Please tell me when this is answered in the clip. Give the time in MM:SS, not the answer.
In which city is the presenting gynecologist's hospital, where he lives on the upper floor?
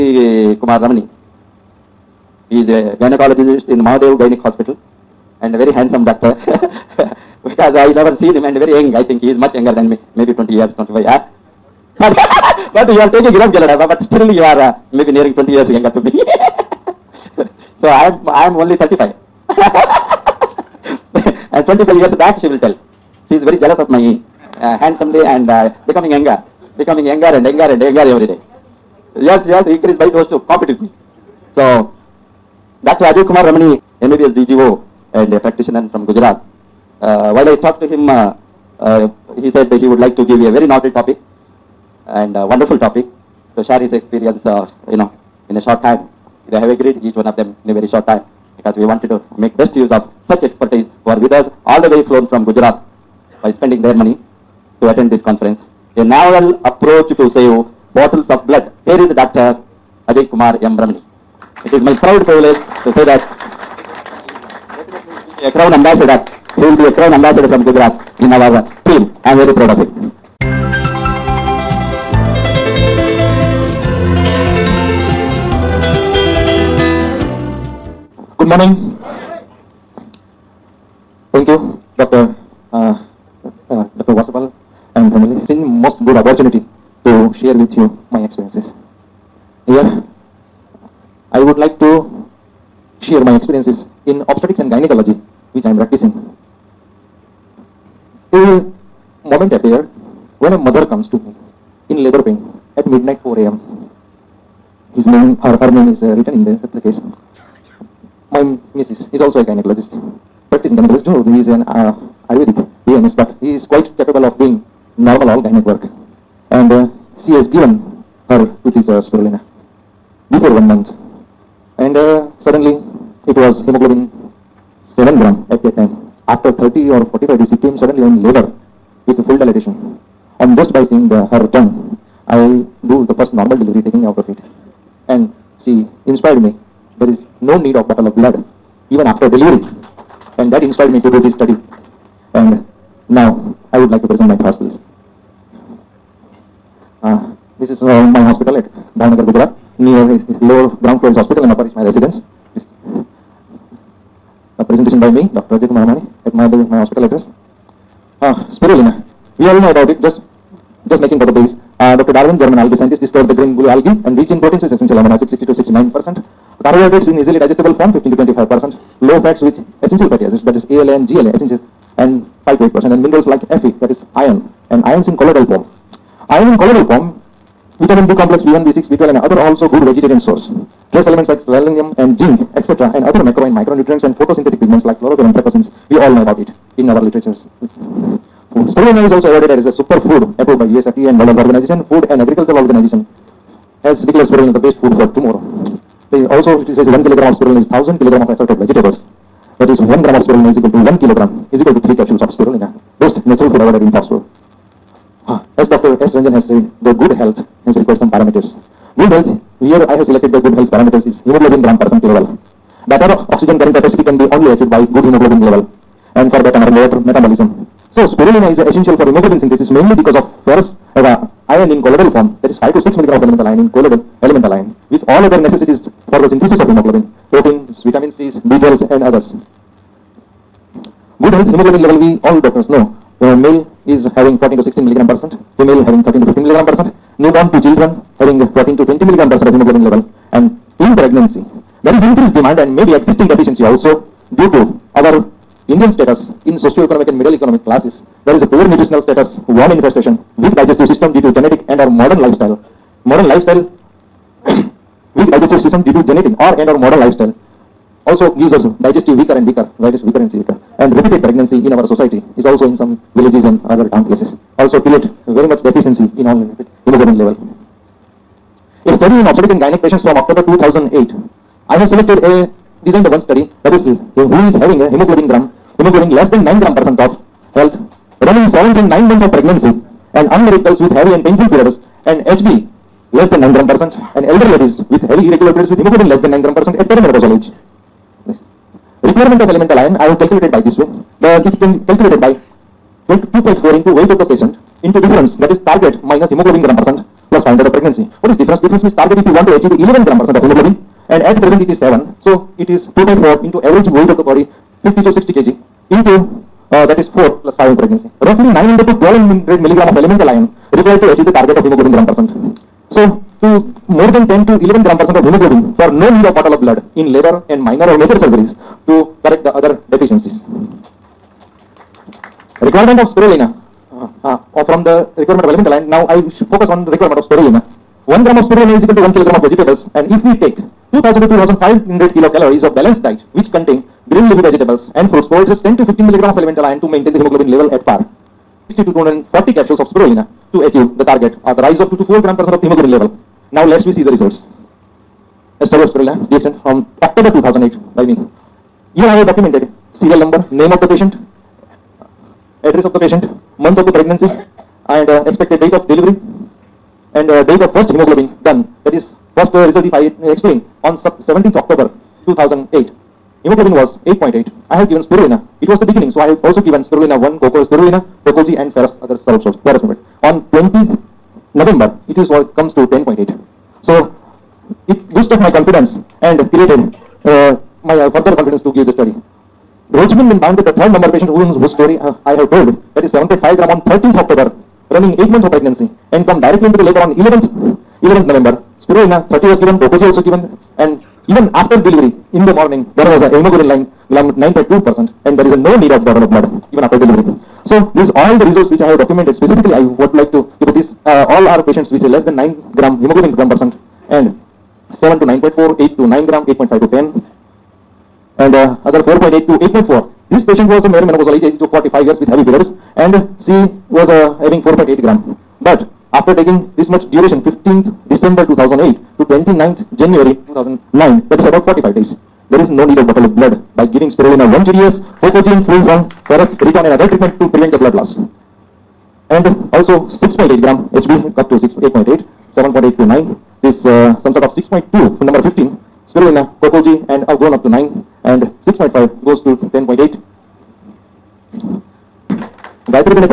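02:28.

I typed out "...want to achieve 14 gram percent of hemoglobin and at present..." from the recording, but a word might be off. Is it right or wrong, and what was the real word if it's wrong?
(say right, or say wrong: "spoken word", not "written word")
wrong: "11", not "14".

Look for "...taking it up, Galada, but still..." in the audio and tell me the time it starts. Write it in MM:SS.
00:13.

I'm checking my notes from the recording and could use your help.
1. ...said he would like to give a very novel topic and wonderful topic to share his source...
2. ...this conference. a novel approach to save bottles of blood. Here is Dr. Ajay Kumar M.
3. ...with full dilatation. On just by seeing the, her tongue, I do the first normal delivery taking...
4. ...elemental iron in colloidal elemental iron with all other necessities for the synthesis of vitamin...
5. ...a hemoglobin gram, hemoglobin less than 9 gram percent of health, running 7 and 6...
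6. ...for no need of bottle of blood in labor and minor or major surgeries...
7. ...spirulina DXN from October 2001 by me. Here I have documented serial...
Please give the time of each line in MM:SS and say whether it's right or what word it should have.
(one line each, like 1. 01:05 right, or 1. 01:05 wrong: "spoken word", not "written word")
1. 00:39 wrong: "experience", not "source"
2. 00:55 right
3. 02:09 right
4. 03:43 wrong: "hemoglobin", not "vitamin"
5. 04:34 wrong: "9", not "6"
6. 05:15 right
7. 05:45 wrong: "2008", not "2001".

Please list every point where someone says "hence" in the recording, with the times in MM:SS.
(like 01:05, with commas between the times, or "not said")
03:27.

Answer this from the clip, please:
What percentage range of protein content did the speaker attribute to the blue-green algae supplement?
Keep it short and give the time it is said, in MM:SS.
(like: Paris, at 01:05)
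60 to 69 percent, at 02:45.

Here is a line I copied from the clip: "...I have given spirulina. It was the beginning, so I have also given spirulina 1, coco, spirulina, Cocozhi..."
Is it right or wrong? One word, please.
right.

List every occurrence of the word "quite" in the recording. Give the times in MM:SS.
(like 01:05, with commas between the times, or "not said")
01:53.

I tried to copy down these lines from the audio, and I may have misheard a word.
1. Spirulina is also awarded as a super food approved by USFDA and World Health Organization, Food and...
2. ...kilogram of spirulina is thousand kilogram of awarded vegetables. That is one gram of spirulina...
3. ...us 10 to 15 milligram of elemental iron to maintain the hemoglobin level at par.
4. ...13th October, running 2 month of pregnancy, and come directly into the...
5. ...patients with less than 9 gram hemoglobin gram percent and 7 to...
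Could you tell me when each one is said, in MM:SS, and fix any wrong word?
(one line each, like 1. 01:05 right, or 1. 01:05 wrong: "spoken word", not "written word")
1. 03:08 right
2. 03:17 wrong: "assorted", not "awarded"
3. 05:35 right
4. 06:23 wrong: "8", not "2"
5. 06:41 right.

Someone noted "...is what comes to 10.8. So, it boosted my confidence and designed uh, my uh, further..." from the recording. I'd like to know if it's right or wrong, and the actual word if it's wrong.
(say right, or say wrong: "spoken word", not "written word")
wrong: "created", not "designed".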